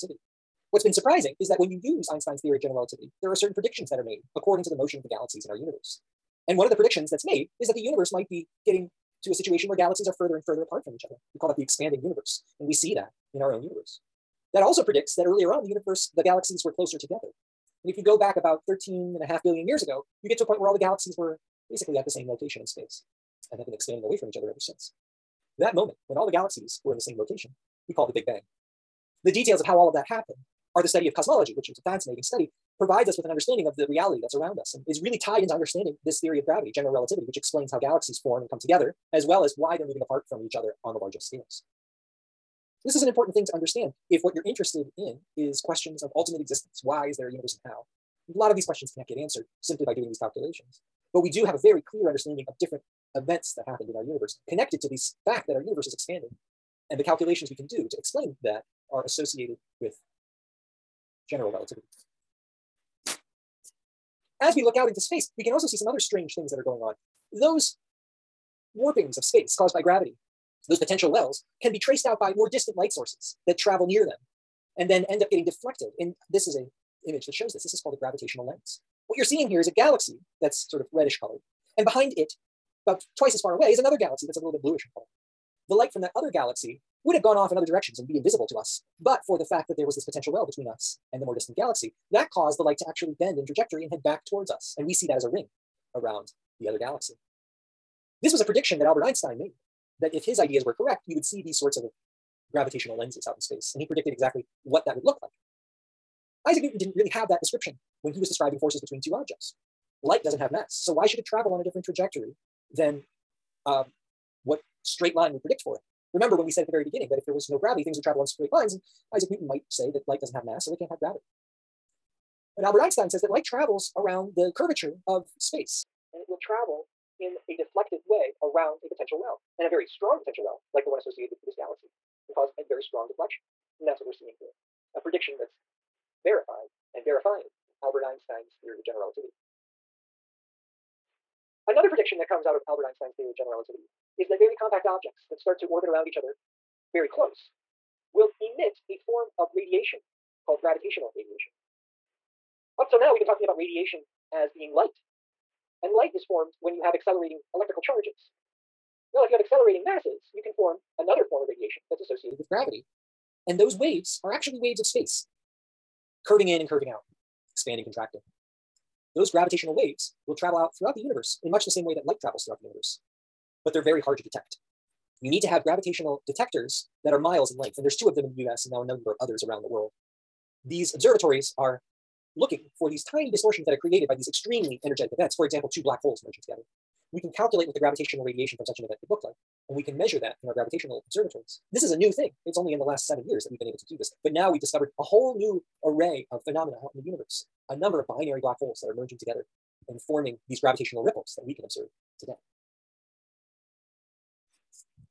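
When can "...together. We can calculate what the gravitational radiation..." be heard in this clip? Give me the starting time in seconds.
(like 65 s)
186 s.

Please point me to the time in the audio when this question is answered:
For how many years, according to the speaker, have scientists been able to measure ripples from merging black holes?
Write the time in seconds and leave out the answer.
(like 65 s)
193 s.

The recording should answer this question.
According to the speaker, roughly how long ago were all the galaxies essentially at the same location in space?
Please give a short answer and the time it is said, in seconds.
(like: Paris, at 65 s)
13.5 billion years, at 18 s.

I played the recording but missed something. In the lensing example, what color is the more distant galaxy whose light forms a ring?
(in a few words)
bluish.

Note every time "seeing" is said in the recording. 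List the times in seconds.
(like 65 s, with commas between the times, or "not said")
79 s, 134 s.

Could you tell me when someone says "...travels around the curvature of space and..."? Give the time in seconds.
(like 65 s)
123 s.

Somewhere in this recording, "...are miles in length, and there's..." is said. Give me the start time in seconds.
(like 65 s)
177 s.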